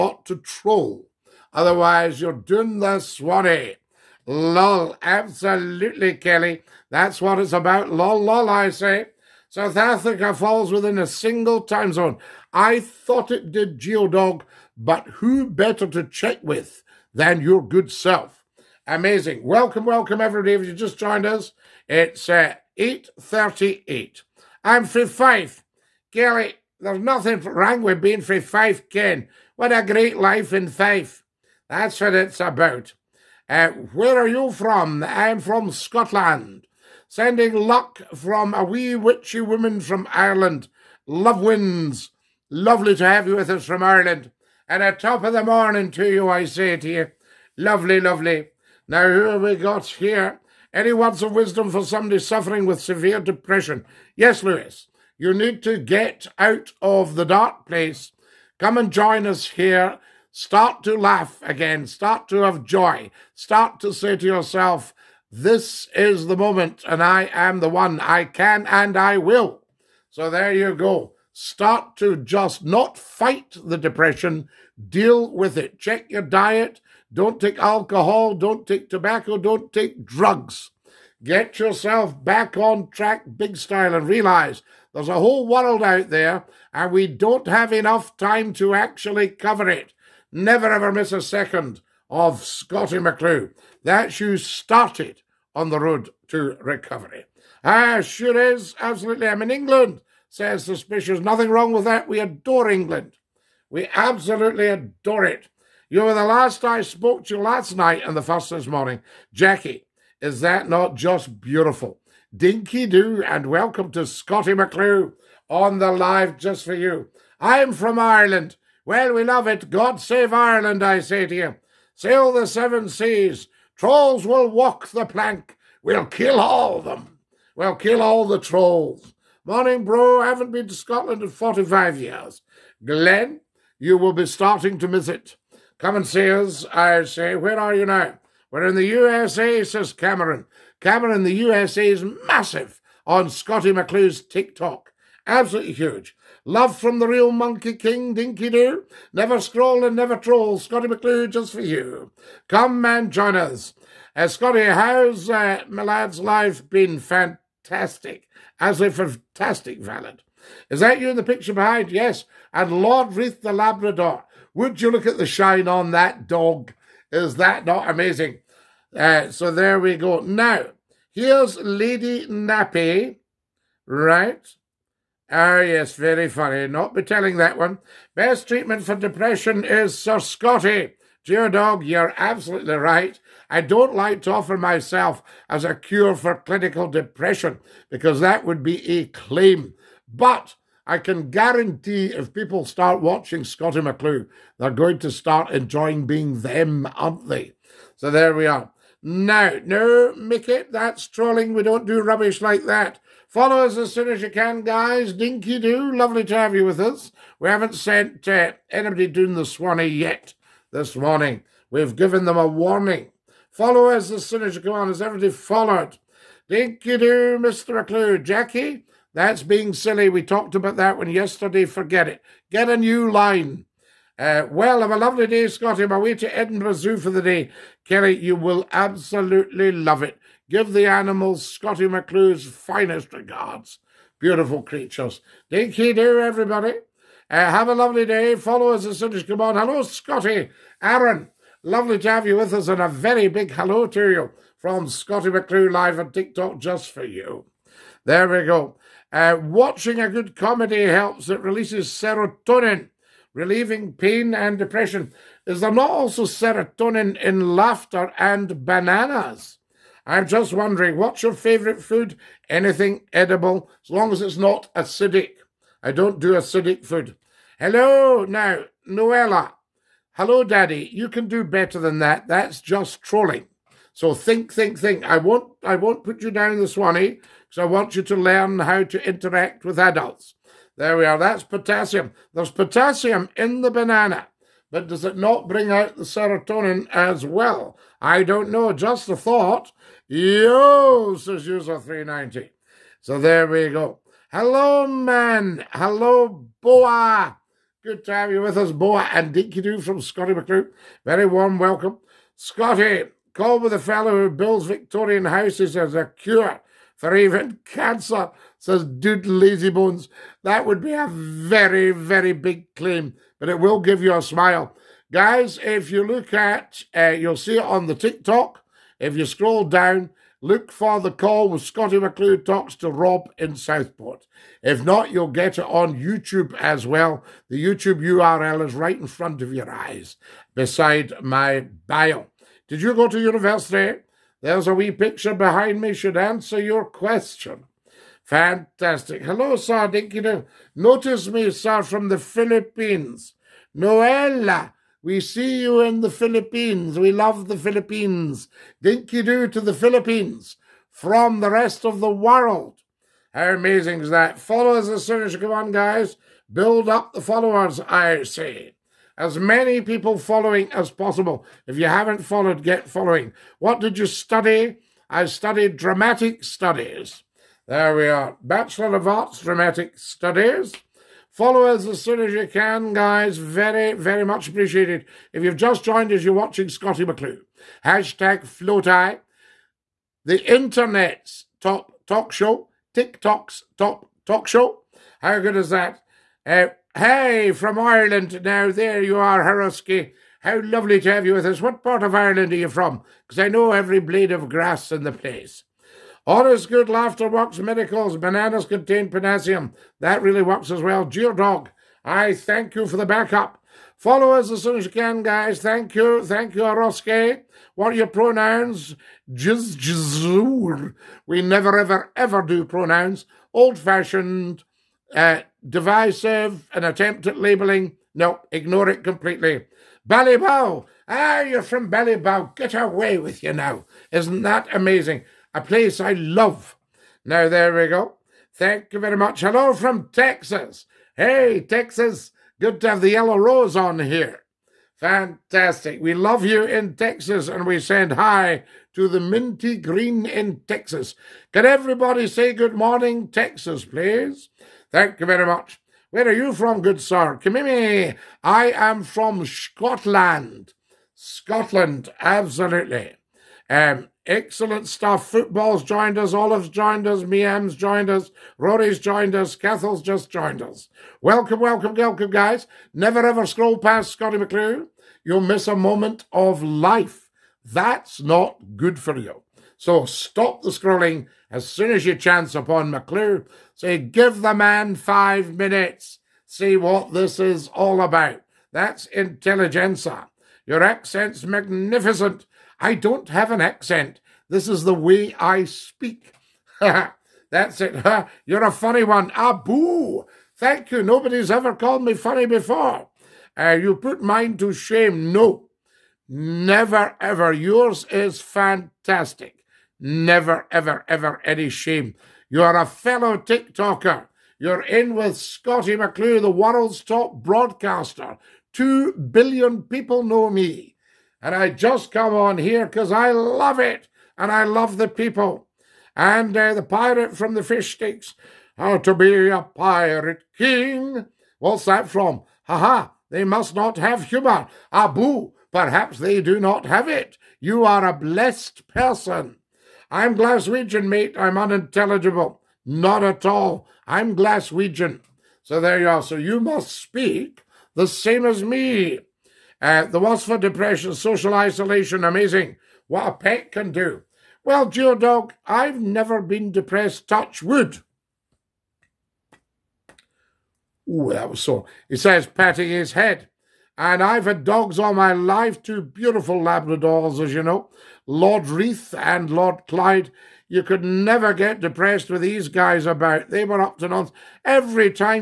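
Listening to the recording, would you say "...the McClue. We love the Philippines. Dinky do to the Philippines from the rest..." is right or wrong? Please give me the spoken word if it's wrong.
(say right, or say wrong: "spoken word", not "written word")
wrong: "Philippines", not "McClue".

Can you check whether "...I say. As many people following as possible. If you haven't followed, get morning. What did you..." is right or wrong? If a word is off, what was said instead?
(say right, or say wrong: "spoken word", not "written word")
wrong: "following", not "morning".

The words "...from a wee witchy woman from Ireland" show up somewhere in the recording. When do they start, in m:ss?
0:38.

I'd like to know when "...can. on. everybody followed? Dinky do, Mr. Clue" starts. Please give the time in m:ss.
3:34.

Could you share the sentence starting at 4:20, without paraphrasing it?
I'm just wondering, what's your favorite food?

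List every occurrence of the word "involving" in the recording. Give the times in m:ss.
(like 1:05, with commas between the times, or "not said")
not said.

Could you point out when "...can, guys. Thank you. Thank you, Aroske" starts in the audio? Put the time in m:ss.
6:44.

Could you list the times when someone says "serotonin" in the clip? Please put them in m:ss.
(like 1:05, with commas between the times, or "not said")
4:11, 4:16, 4:46.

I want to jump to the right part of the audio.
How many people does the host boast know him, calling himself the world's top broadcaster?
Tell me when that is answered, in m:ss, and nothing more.
8:28.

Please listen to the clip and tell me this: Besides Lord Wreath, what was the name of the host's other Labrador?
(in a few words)
Lord Clyde.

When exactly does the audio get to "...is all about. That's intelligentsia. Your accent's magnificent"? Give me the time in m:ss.
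7:57.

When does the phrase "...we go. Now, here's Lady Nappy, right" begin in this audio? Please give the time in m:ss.
2:49.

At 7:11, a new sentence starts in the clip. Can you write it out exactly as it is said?
Hey, Texas, good to have the yellow rose on here.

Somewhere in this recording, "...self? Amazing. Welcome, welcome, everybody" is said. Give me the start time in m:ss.
0:17.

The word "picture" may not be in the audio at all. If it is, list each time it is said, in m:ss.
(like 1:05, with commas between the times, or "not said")
2:41, 5:34.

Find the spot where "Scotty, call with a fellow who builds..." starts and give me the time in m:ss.
5:02.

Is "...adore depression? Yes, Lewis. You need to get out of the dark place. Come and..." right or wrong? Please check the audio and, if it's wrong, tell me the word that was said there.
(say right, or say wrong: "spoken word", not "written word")
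wrong: "severe", not "adore".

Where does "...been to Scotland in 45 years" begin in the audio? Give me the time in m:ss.
2:10.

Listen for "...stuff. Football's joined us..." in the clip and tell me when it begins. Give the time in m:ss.
7:34.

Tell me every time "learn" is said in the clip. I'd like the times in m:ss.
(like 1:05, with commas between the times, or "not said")
4:38.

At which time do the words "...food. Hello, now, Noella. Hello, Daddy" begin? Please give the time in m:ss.
4:26.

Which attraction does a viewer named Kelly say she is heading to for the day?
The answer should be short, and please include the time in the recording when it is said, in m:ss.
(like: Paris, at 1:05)
Edinburgh Zoo, at 3:46.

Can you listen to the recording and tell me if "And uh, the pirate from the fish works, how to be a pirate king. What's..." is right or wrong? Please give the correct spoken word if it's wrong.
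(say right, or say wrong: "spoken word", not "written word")
wrong: "sticks", not "works".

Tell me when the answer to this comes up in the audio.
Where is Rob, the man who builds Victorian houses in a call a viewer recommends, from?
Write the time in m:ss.
5:23.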